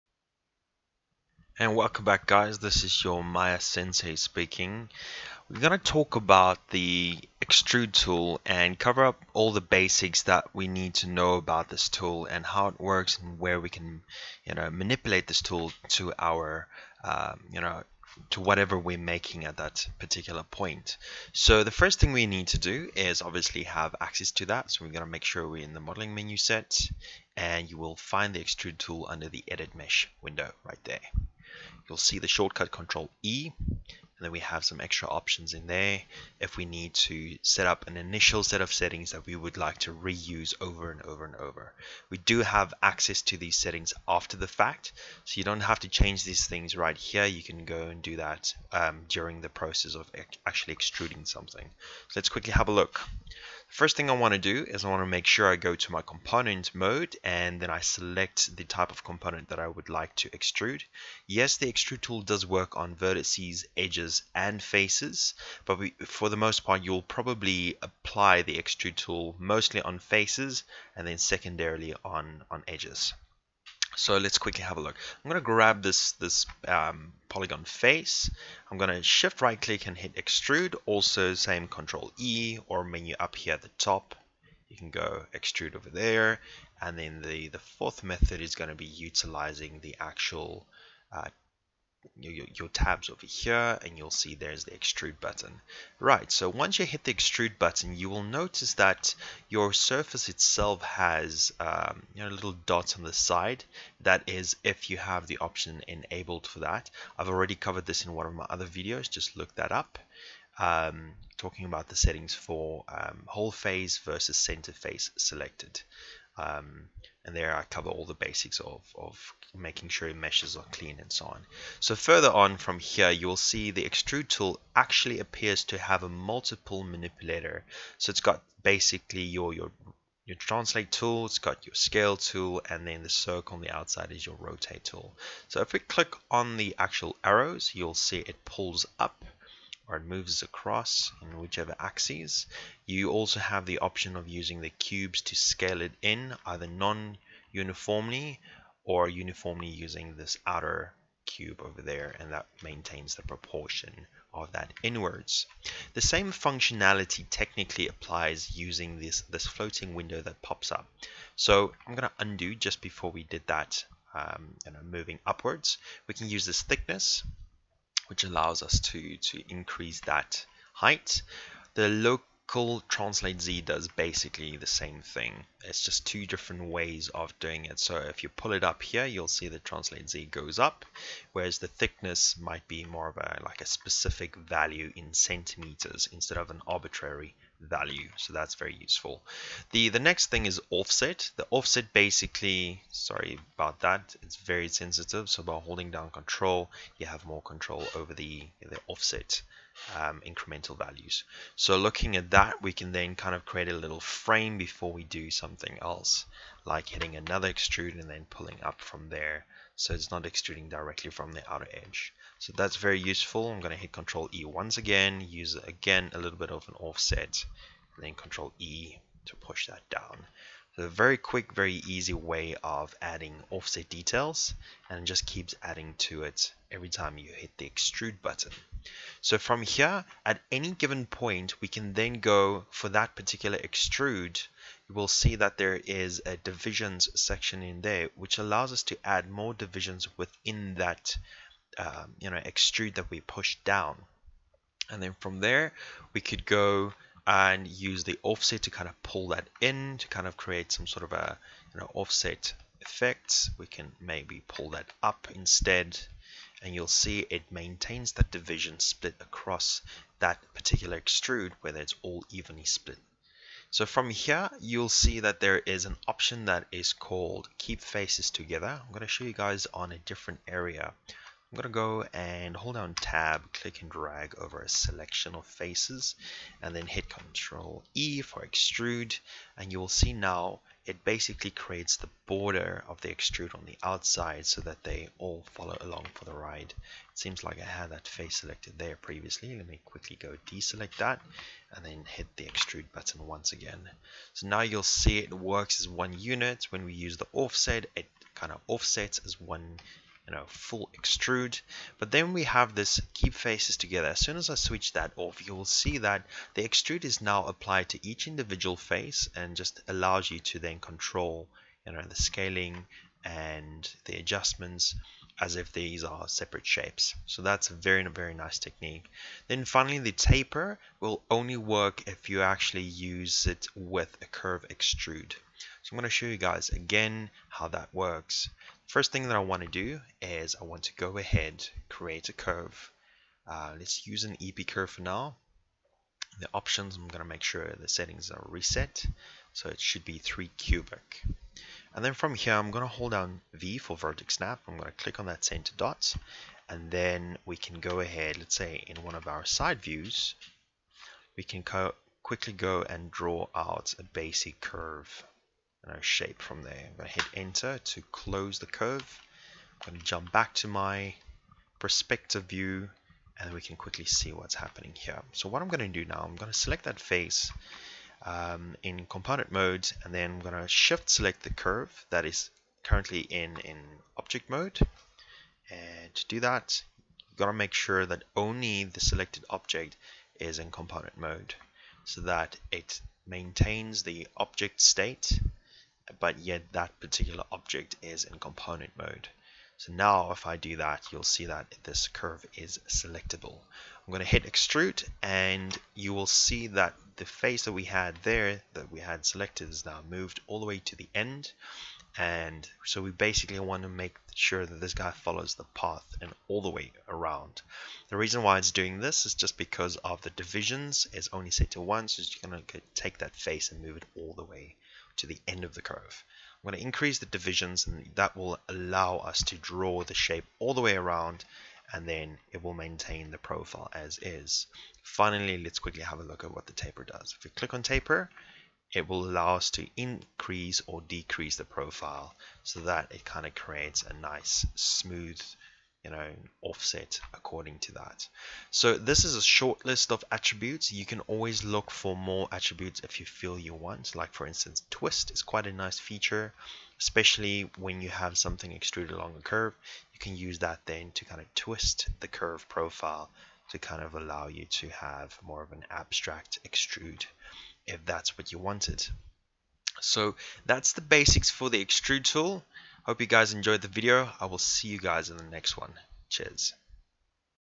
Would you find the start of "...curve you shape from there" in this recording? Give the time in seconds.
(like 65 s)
354 s.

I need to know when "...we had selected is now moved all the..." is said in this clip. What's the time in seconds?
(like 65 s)
398 s.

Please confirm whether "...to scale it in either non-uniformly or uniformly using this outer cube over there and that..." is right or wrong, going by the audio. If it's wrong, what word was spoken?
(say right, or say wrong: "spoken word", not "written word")
right.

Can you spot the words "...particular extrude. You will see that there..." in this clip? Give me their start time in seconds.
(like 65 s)
233 s.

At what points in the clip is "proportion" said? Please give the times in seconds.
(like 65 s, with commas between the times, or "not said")
153 s.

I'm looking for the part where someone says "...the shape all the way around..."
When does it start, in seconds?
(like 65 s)
420 s.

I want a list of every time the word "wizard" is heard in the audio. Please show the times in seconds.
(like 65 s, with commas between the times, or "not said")
not said.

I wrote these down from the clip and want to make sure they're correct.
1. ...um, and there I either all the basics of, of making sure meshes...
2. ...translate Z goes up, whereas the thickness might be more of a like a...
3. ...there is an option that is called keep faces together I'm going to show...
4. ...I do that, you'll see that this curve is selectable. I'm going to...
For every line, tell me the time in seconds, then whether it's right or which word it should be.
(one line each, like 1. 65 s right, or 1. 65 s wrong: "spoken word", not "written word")
1. 116 s wrong: "cover", not "either"
2. 179 s right
3. 265 s right
4. 390 s right.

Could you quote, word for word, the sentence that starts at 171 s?
The local translate Z does basically the same thing.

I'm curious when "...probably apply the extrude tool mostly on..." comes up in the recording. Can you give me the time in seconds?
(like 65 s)
67 s.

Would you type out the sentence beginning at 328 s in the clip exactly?
First thing that I want to do is I want to go ahead, create a curve.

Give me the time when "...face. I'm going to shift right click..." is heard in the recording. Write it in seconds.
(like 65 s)
77 s.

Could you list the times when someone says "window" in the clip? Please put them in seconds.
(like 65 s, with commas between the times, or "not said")
30 s, 159 s.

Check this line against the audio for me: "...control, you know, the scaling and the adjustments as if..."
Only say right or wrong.
right.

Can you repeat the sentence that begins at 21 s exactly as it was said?
So the first thing we need to do is obviously have access to that.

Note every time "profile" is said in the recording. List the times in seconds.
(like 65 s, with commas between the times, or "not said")
423 s, 431 s, 452 s.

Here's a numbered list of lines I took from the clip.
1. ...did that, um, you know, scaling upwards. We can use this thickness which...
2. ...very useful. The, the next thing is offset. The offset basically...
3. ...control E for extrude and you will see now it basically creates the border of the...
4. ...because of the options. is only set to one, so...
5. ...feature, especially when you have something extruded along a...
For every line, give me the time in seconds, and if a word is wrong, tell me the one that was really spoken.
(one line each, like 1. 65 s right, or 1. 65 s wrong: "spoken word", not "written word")
1. 163 s wrong: "moving", not "scaling"
2. 188 s right
3. 277 s right
4. 409 s wrong: "divisions", not "options"
5. 445 s right.